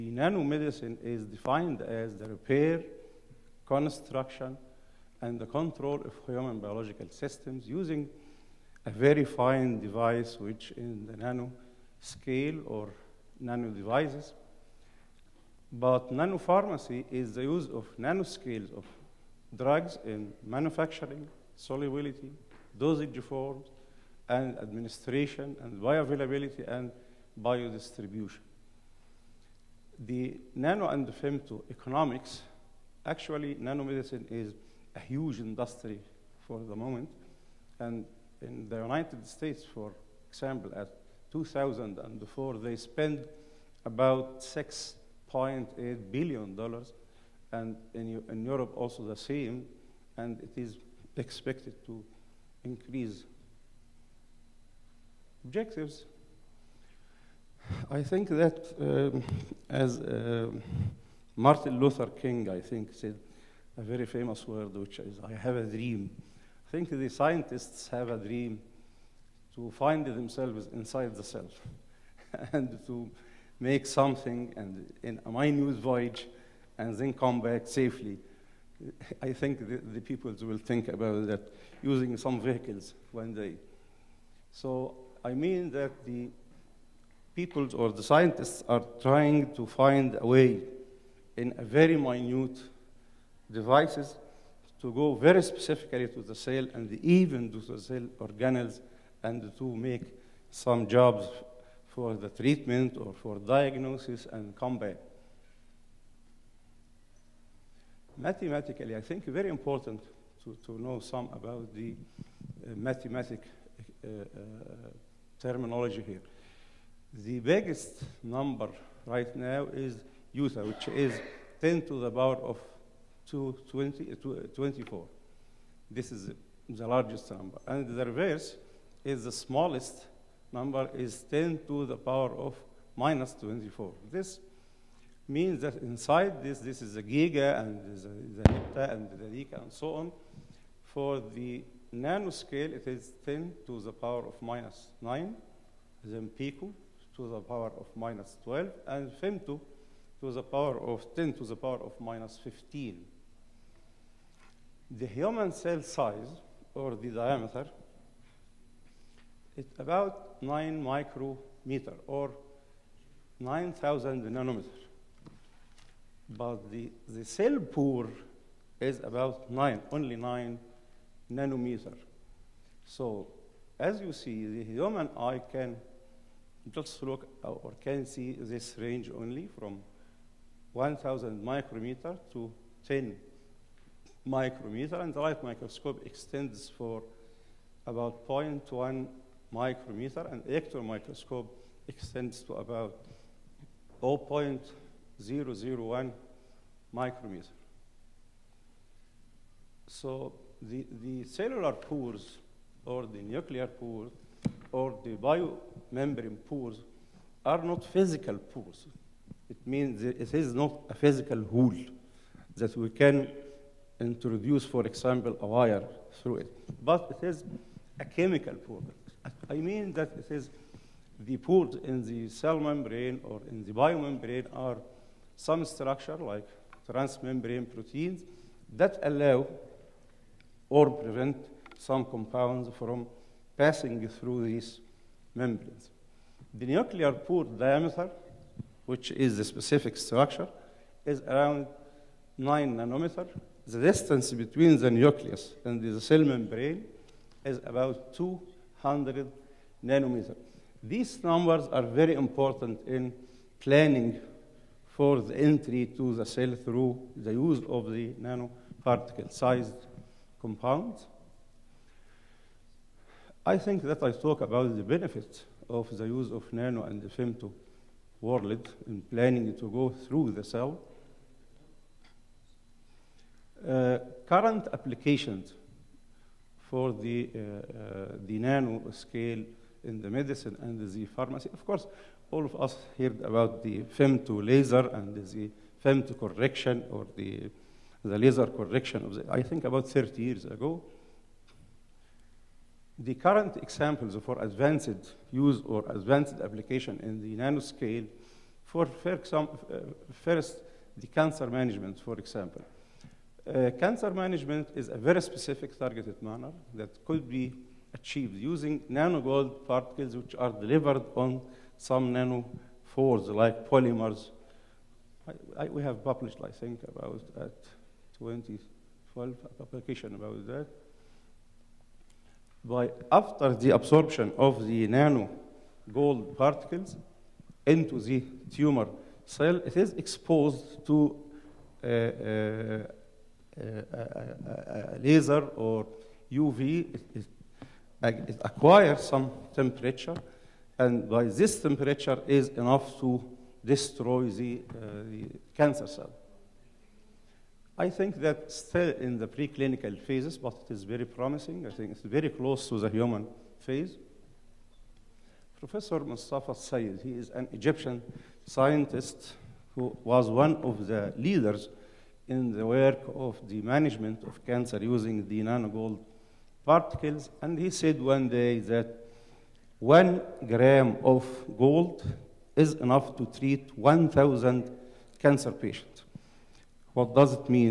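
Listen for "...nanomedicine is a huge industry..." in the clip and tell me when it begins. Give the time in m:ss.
0:33.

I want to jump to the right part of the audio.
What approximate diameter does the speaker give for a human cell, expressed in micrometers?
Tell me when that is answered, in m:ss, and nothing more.
2:40.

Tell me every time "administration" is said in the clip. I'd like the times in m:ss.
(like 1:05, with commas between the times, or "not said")
0:24.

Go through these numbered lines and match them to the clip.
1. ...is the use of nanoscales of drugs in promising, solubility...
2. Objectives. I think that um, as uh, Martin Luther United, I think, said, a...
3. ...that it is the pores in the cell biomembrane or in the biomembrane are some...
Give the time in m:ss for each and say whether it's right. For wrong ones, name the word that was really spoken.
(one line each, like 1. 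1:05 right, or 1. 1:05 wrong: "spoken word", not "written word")
1. 0:17 wrong: "manufacturing", not "promising"
2. 0:55 wrong: "King", not "United"
3. 3:39 wrong: "membrane", not "biomembrane".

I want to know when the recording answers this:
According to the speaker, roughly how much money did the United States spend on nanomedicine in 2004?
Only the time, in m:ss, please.
0:44.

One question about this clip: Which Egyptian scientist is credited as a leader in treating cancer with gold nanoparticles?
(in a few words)
Mustafa Sayed.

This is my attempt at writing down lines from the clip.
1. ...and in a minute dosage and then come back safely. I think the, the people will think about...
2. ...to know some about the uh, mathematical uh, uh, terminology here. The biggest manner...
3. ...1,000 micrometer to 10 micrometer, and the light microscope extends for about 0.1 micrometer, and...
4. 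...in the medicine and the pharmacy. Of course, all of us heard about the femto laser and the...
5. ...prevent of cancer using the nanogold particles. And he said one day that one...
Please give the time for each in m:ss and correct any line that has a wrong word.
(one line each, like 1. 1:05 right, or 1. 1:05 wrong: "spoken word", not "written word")
1. 1:14 wrong: "voyage", not "dosage"
2. 1:50 wrong: "number", not "manner"
3. 3:00 right
4. 4:39 right
5. 6:03 wrong: "management", not "prevent".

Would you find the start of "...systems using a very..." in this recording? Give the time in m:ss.
0:07.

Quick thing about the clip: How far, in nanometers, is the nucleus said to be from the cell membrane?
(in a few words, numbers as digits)
200 nanometers.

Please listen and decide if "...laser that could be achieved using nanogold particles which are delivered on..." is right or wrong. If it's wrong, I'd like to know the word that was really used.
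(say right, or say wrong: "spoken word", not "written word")
wrong: "manner", not "laser".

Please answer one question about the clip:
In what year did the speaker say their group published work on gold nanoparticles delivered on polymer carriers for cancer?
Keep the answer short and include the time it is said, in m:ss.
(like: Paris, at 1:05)
2012, at 5:18.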